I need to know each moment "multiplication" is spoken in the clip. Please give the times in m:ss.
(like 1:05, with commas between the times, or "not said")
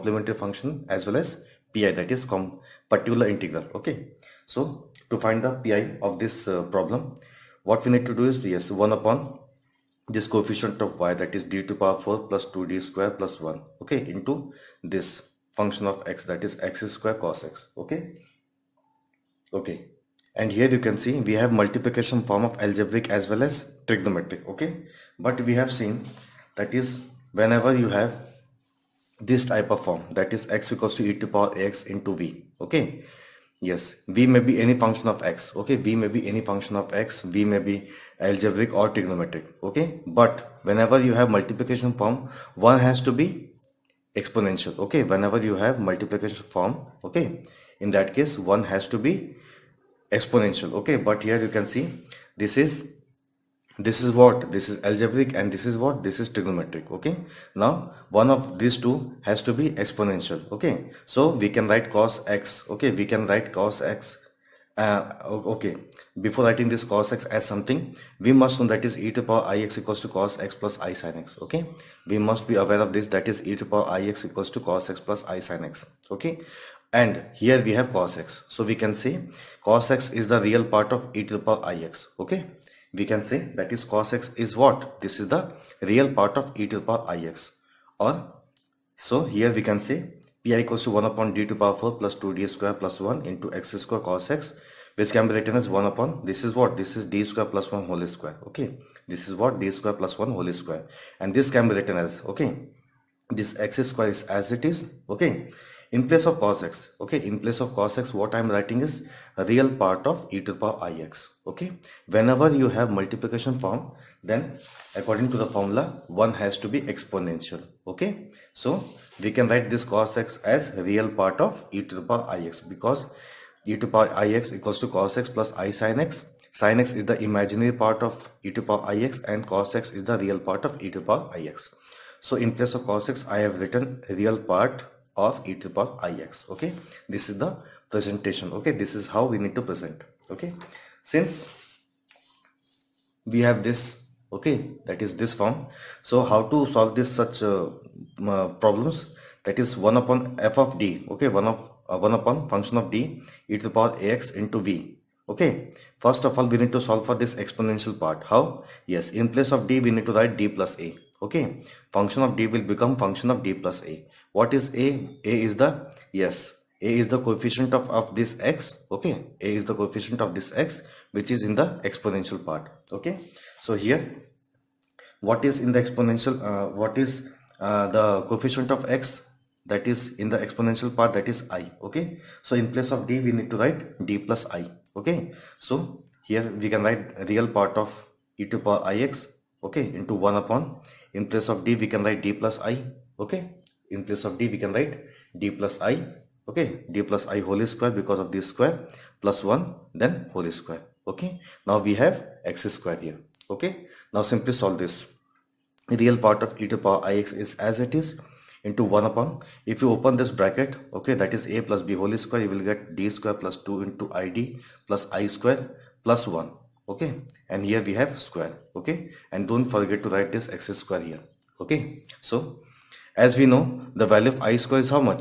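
0:21, 0:41, 0:45, 1:52.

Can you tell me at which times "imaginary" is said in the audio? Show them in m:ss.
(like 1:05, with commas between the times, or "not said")
2:07.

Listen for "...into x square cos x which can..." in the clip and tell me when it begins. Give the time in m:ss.
1:33.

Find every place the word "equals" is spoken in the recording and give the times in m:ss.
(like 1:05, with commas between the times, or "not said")
0:30, 1:09, 1:14, 1:30, 2:04.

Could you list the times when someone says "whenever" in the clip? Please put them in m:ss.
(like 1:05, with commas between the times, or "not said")
0:27, 0:40, 0:45, 1:52.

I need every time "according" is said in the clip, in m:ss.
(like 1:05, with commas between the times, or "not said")
1:54.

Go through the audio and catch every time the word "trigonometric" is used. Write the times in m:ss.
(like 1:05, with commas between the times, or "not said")
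0:23, 0:38, 0:56.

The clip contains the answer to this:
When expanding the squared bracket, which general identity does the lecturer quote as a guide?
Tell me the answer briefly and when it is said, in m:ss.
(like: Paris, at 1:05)
a plus b whole square, at 3:31.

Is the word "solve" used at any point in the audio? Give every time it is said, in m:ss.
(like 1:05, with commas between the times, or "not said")
2:26, 2:36, 3:24.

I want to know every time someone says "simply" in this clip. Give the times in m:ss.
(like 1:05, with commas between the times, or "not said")
3:24.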